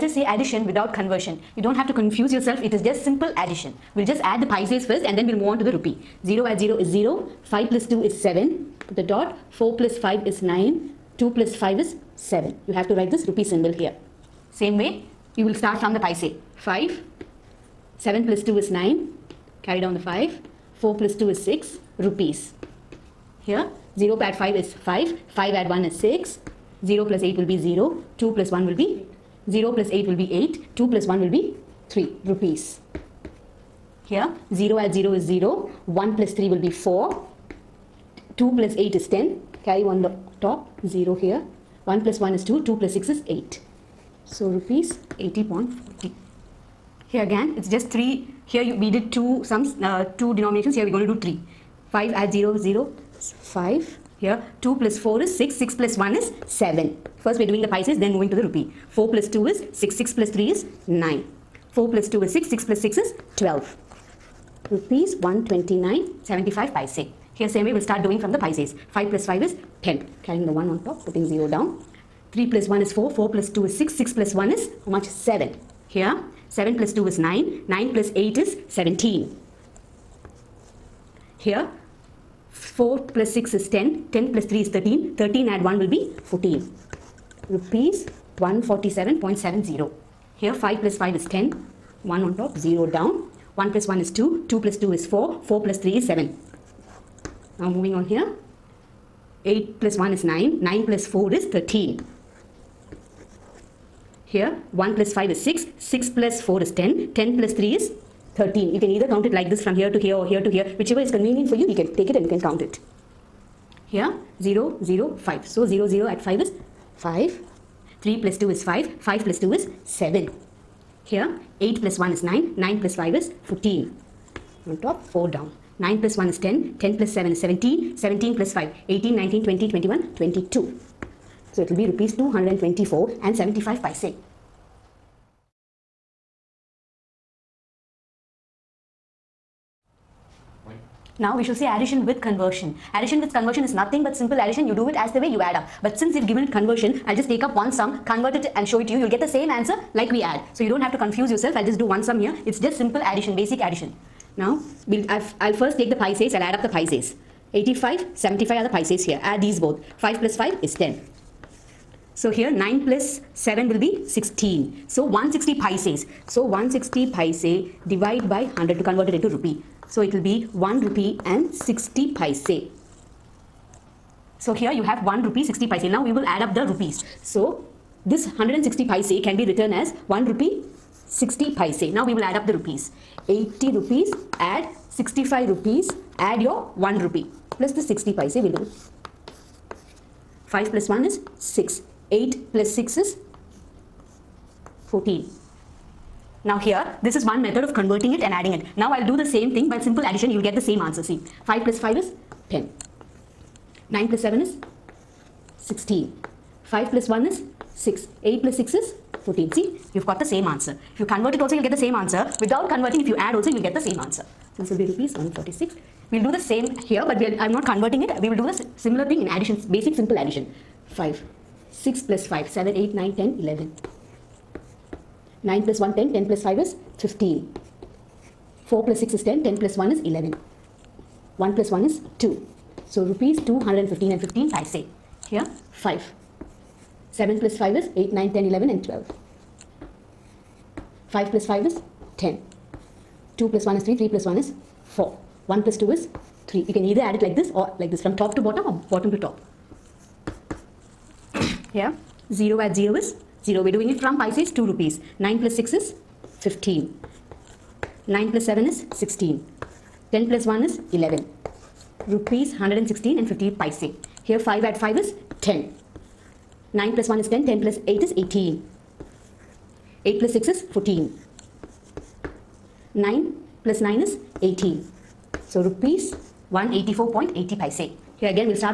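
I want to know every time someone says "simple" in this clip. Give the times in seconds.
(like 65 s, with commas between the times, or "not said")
3 s, 144 s, 152 s, 199 s, 219 s.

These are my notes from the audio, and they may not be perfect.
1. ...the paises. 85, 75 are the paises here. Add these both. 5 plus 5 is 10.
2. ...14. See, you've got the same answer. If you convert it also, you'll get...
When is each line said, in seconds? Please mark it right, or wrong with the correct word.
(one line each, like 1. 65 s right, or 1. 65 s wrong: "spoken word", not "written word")
1. 156 s right
2. 209 s right.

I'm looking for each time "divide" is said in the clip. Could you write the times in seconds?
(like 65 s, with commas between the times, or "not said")
167 s.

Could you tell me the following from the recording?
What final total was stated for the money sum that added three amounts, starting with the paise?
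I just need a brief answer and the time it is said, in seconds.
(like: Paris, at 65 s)
Rs 129.75, at 64 s.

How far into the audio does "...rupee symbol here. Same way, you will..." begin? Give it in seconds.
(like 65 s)
13 s.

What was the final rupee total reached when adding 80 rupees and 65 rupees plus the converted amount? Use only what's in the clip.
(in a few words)
Rs 146.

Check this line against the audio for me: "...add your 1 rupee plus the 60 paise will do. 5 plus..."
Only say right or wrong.
right.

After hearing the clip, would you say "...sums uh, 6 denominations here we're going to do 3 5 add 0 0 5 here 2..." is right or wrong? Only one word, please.
wrong.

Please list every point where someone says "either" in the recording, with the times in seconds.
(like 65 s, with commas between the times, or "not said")
108 s, 246 s.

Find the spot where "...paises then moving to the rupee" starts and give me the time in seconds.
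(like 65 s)
57 s.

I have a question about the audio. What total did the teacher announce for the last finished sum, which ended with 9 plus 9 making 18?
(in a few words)
Rs 184.80.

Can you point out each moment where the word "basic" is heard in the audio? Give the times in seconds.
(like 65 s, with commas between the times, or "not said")
153 s, 219 s.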